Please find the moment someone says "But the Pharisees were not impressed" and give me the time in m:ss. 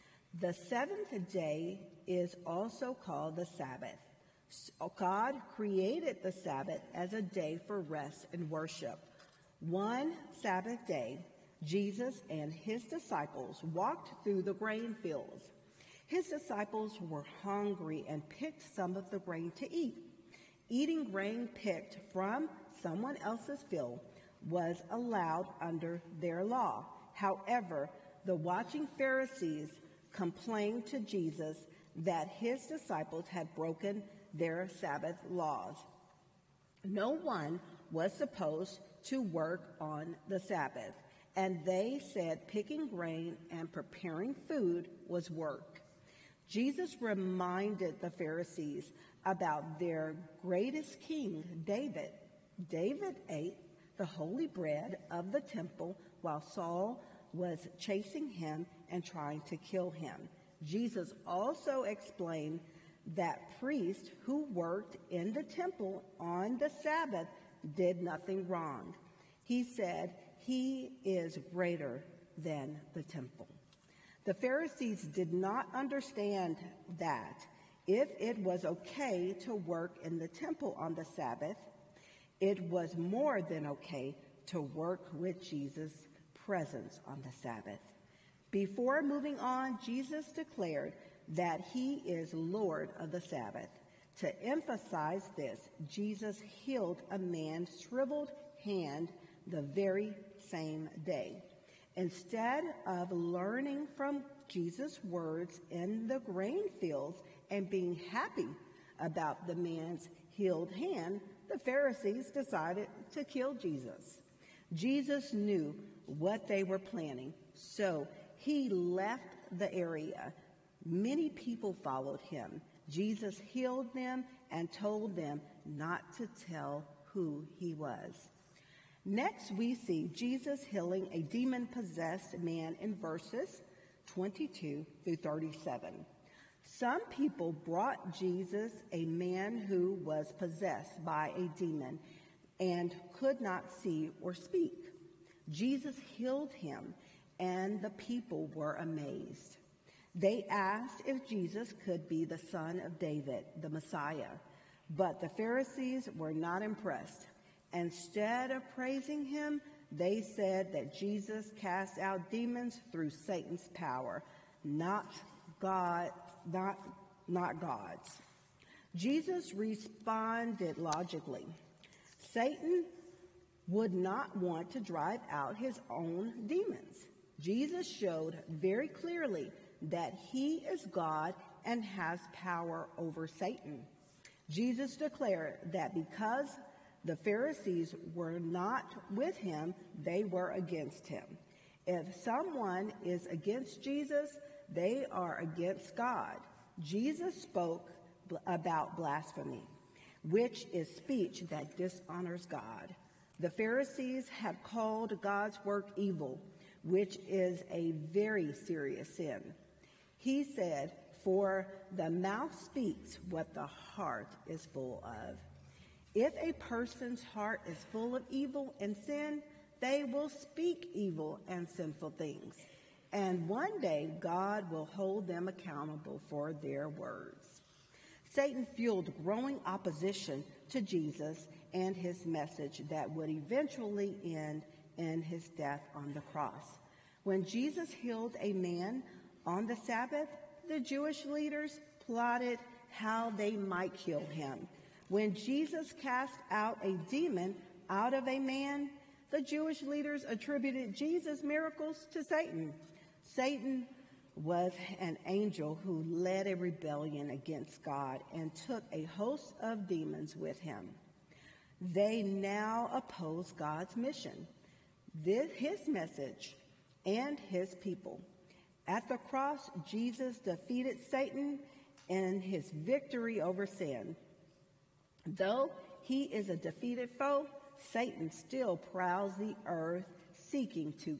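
2:34.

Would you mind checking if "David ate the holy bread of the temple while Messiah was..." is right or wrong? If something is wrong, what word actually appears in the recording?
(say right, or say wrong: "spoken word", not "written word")
wrong: "Saul", not "Messiah".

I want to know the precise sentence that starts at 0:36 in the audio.
No one was supposed to work on the Sabbath, and they said picking grain and preparing food was work.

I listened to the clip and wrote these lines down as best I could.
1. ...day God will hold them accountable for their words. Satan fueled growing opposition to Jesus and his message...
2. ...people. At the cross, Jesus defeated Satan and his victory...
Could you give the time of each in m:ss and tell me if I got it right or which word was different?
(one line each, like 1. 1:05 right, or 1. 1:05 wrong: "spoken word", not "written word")
1. 3:43 right
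2. 4:27 right.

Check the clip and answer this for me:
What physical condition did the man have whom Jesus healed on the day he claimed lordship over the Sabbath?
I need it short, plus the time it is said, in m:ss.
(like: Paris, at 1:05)
Shriveled hand, at 1:37.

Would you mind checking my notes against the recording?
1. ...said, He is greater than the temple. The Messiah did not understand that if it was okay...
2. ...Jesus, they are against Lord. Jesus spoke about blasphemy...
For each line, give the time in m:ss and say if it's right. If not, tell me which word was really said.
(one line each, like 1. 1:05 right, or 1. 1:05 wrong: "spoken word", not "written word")
1. 1:09 wrong: "Pharisees", not "Messiah"
2. 3:13 wrong: "God", not "Lord".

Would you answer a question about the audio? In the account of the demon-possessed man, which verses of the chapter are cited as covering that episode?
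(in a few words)
22 through 37.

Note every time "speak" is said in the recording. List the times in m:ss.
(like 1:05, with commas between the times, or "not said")
2:24, 3:32, 3:40.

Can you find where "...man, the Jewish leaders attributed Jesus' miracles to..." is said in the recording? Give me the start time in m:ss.
4:08.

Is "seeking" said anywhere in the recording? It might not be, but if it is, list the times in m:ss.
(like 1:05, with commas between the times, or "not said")
4:40.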